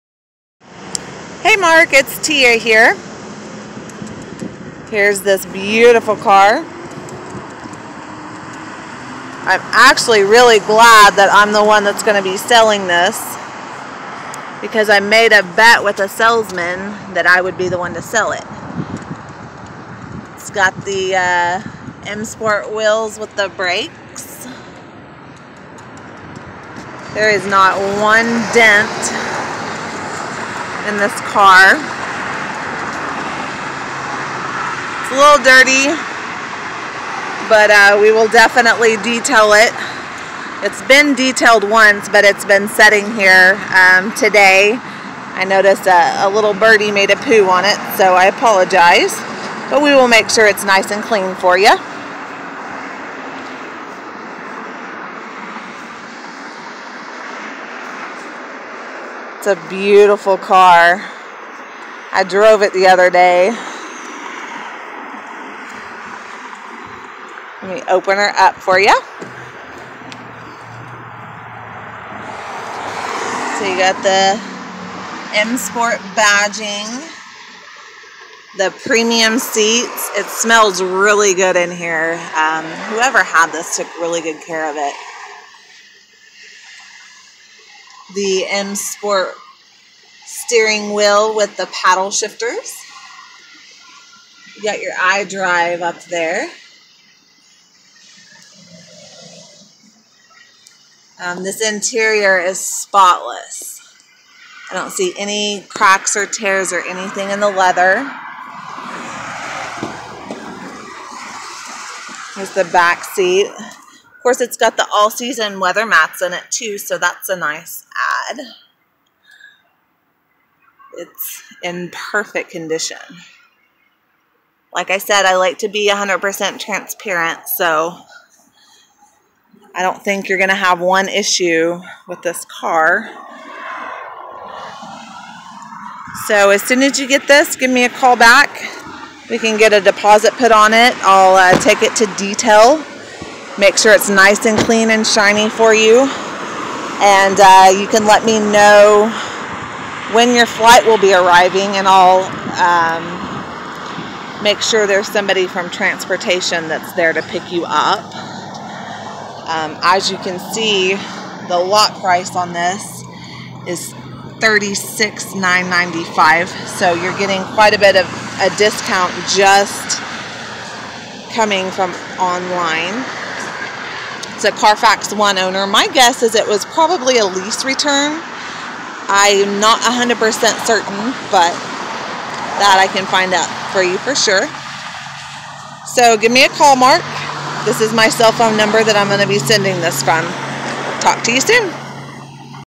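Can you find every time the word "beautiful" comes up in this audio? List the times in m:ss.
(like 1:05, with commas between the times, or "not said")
0:05, 0:59.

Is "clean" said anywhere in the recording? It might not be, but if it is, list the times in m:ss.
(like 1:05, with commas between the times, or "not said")
0:51, 2:24.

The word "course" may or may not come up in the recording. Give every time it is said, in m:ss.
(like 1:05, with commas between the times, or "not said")
1:54.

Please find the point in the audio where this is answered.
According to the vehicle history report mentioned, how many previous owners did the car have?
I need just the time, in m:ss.
2:55.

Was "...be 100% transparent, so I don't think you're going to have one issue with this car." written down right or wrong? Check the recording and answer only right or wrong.
right.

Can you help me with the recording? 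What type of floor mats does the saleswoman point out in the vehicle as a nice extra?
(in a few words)
all-season weather mats.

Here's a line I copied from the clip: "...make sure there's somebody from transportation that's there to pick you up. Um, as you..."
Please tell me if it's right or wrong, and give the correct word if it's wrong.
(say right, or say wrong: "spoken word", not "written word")
right.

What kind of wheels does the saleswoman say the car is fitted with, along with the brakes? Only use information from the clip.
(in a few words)
M Sport wheels.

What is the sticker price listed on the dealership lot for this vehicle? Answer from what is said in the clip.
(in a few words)
$36,995.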